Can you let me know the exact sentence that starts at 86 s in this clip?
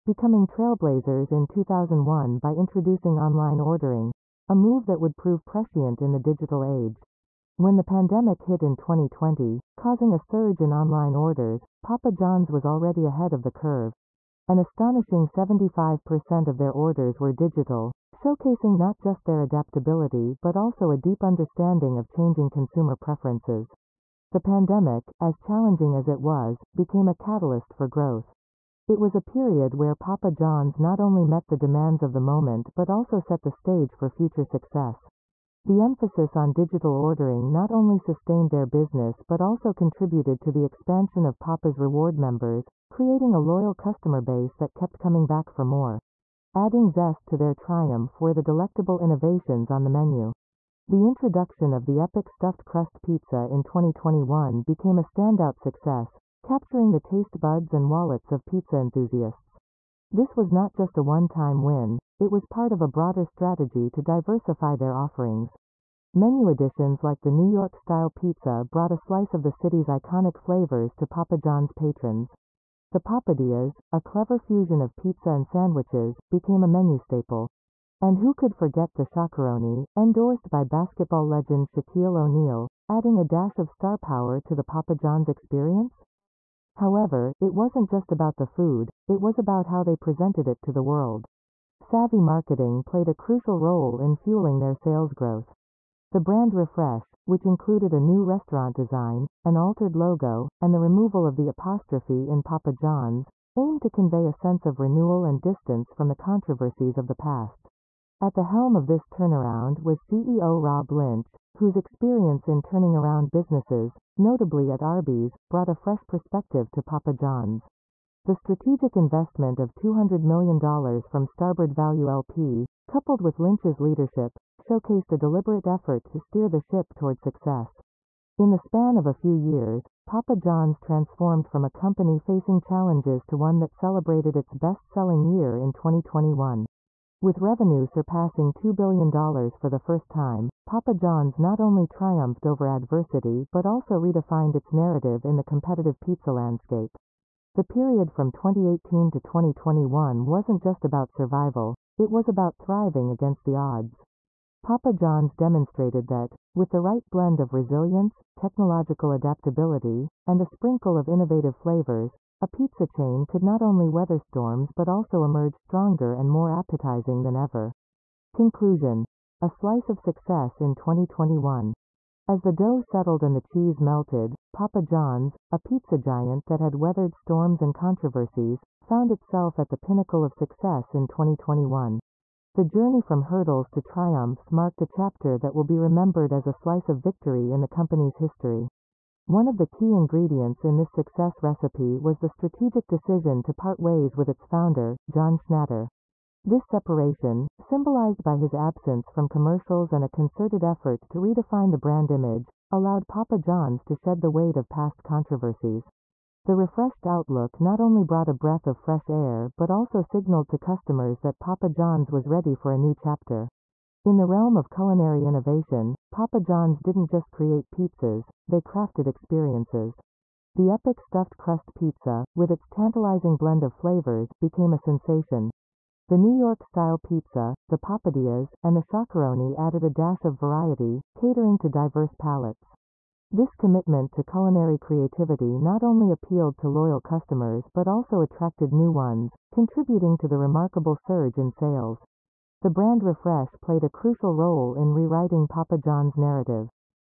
However, it wasn't just about the food, it was about how they presented it to the world.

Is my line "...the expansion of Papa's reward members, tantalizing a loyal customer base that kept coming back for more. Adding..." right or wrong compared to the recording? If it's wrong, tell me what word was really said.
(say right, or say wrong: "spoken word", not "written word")
wrong: "creating", not "tantalizing".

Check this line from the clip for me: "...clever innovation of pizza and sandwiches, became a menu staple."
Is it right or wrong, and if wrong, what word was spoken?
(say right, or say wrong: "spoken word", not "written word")
wrong: "fusion", not "innovation".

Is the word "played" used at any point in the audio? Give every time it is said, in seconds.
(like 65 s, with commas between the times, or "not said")
92 s, 243 s.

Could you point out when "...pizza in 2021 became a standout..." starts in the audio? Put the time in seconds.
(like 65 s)
53 s.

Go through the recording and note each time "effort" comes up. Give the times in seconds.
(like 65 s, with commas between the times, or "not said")
125 s, 200 s.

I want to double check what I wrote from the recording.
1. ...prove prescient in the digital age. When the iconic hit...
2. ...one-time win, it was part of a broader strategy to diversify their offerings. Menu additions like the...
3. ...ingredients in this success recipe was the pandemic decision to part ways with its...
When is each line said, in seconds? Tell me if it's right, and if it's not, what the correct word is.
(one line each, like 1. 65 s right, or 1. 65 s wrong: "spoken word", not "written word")
1. 5 s wrong: "pandemic", not "iconic"
2. 61 s right
3. 189 s wrong: "strategic", not "pandemic".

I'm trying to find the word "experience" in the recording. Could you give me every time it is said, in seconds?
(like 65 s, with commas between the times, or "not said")
85 s, 111 s, 219 s.